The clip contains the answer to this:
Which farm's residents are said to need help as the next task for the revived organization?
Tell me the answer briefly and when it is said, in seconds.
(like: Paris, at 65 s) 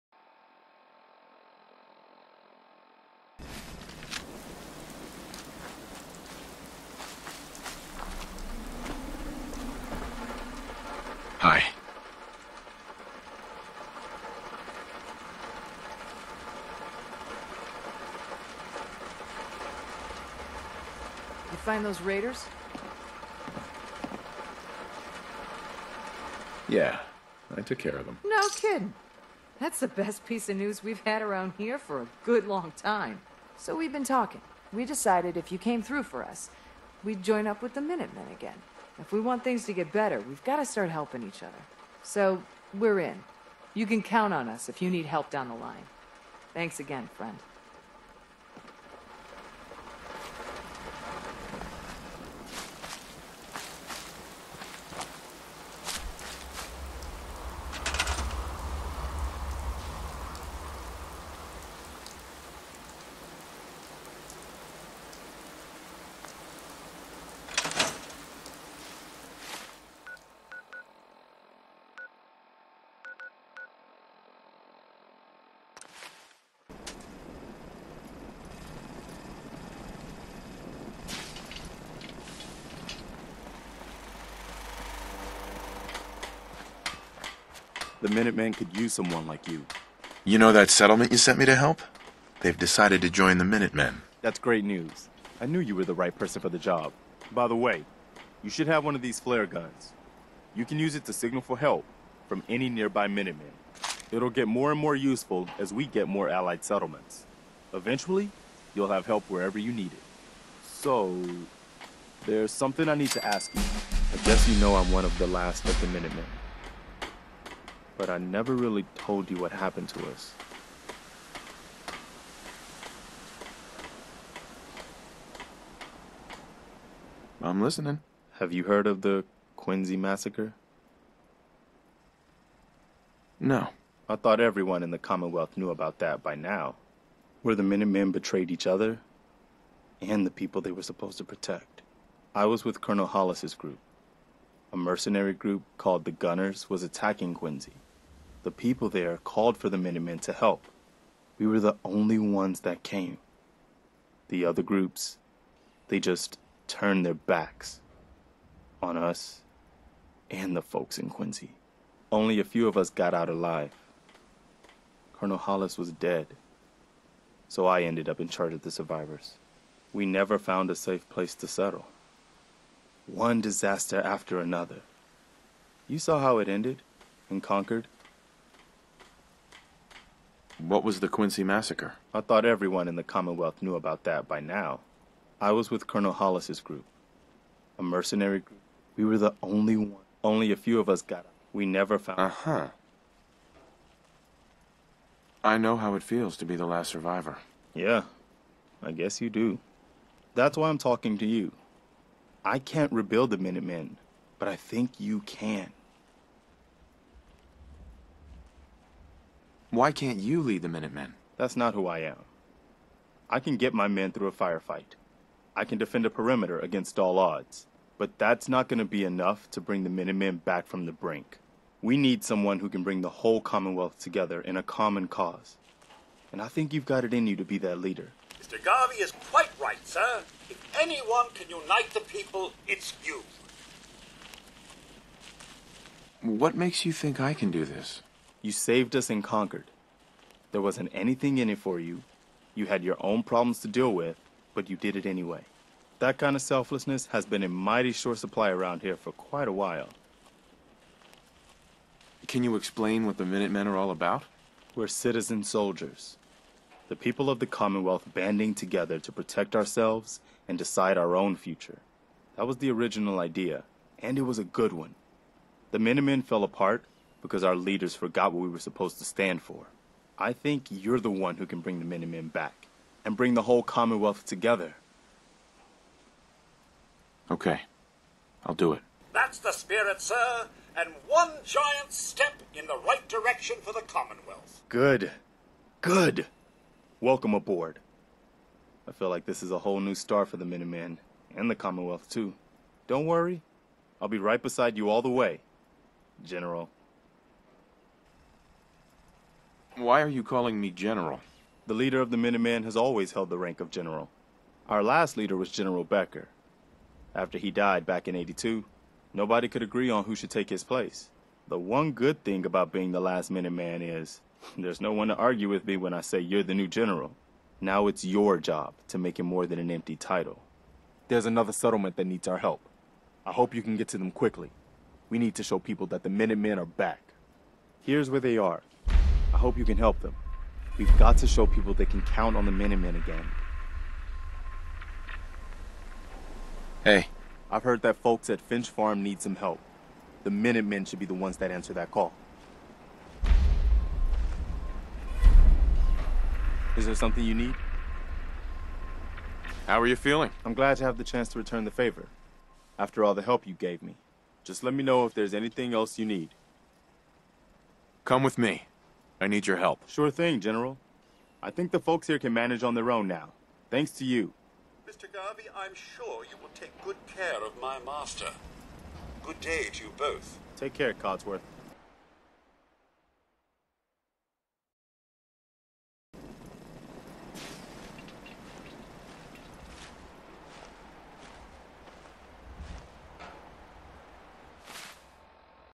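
Finch Farm, at 338 s.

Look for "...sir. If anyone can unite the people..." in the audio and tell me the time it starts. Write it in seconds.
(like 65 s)
229 s.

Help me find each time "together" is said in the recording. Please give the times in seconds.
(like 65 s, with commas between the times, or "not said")
223 s, 258 s, 274 s.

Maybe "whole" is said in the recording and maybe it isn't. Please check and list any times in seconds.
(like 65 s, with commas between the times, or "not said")
223 s, 273 s, 289 s.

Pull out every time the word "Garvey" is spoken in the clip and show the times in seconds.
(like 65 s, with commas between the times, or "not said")
228 s, 365 s.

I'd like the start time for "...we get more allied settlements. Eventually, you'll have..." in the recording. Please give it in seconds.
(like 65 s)
105 s.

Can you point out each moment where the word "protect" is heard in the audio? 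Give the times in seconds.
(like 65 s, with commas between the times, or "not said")
141 s, 259 s.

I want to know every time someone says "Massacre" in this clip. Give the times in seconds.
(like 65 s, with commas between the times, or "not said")
129 s, 181 s.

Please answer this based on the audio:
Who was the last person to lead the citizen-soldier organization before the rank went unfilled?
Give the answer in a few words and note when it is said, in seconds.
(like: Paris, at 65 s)
General Becker, at 305 s.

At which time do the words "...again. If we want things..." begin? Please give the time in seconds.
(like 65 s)
38 s.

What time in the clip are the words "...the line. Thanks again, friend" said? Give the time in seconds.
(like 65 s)
45 s.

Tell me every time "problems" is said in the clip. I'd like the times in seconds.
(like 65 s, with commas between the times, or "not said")
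243 s.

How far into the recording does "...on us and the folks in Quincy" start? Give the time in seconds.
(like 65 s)
158 s.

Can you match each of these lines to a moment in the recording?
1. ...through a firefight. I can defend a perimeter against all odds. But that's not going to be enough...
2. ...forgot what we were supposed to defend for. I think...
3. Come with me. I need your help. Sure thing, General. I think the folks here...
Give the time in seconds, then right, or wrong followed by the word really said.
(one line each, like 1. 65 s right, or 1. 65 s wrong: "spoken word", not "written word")
1. 214 s right
2. 267 s wrong: "stand", not "defend"
3. 358 s right.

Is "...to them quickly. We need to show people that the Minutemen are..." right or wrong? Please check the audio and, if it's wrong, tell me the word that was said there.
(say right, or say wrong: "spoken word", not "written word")
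right.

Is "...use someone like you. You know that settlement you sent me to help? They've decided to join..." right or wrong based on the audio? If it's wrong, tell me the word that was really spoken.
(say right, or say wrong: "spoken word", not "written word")
right.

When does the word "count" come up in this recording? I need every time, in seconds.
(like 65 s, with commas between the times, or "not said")
44 s, 332 s.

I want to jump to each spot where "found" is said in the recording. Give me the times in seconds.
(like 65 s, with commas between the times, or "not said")
170 s, 191 s.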